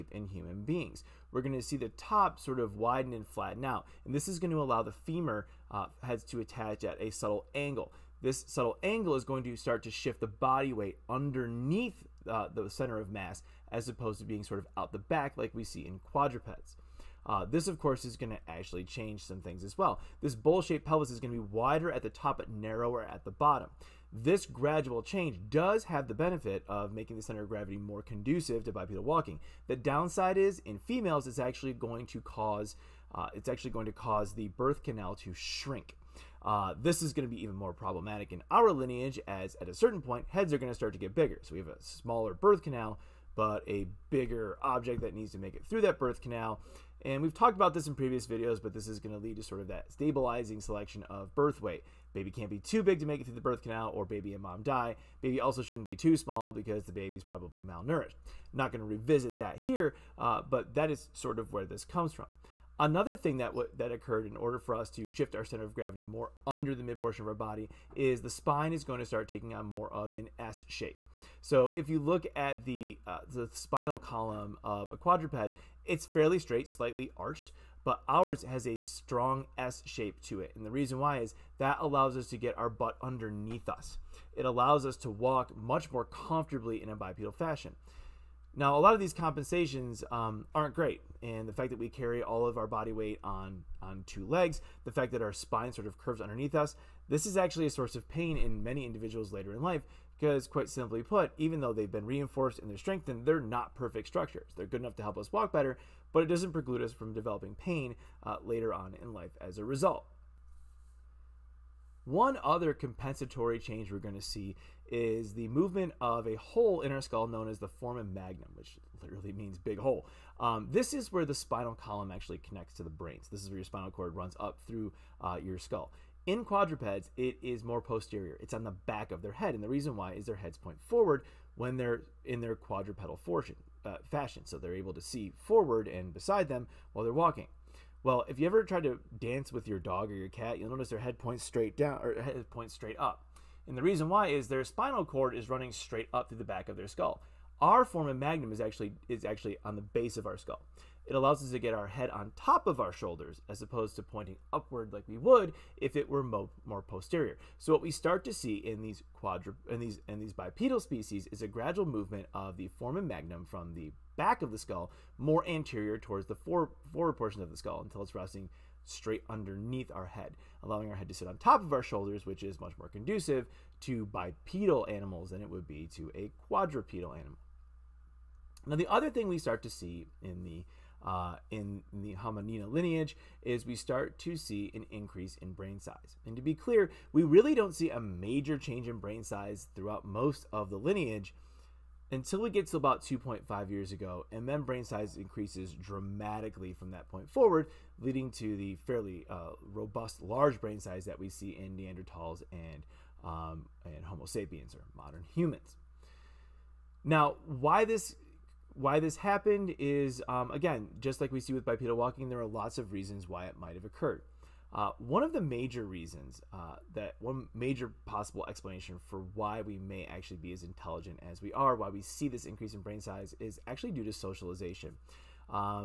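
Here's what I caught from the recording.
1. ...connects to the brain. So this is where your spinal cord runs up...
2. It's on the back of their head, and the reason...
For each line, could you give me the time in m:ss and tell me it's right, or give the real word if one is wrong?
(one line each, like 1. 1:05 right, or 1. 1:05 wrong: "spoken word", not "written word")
1. 2:02 right
2. 2:08 right.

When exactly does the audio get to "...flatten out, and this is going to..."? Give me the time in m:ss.
0:03.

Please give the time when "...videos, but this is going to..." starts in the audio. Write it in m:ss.
0:48.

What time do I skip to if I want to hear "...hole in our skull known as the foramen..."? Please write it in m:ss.
1:56.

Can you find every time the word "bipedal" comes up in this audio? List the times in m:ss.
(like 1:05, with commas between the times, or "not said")
0:28, 1:26, 2:40, 2:54, 3:31.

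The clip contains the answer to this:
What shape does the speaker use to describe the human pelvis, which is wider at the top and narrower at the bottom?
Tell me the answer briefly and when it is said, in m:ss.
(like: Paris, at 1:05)
Bowl-shaped, at 0:20.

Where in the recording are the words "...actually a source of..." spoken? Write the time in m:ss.
1:37.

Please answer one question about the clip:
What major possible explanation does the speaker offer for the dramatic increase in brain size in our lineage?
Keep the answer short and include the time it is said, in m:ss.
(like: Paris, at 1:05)
Socialization, at 3:44.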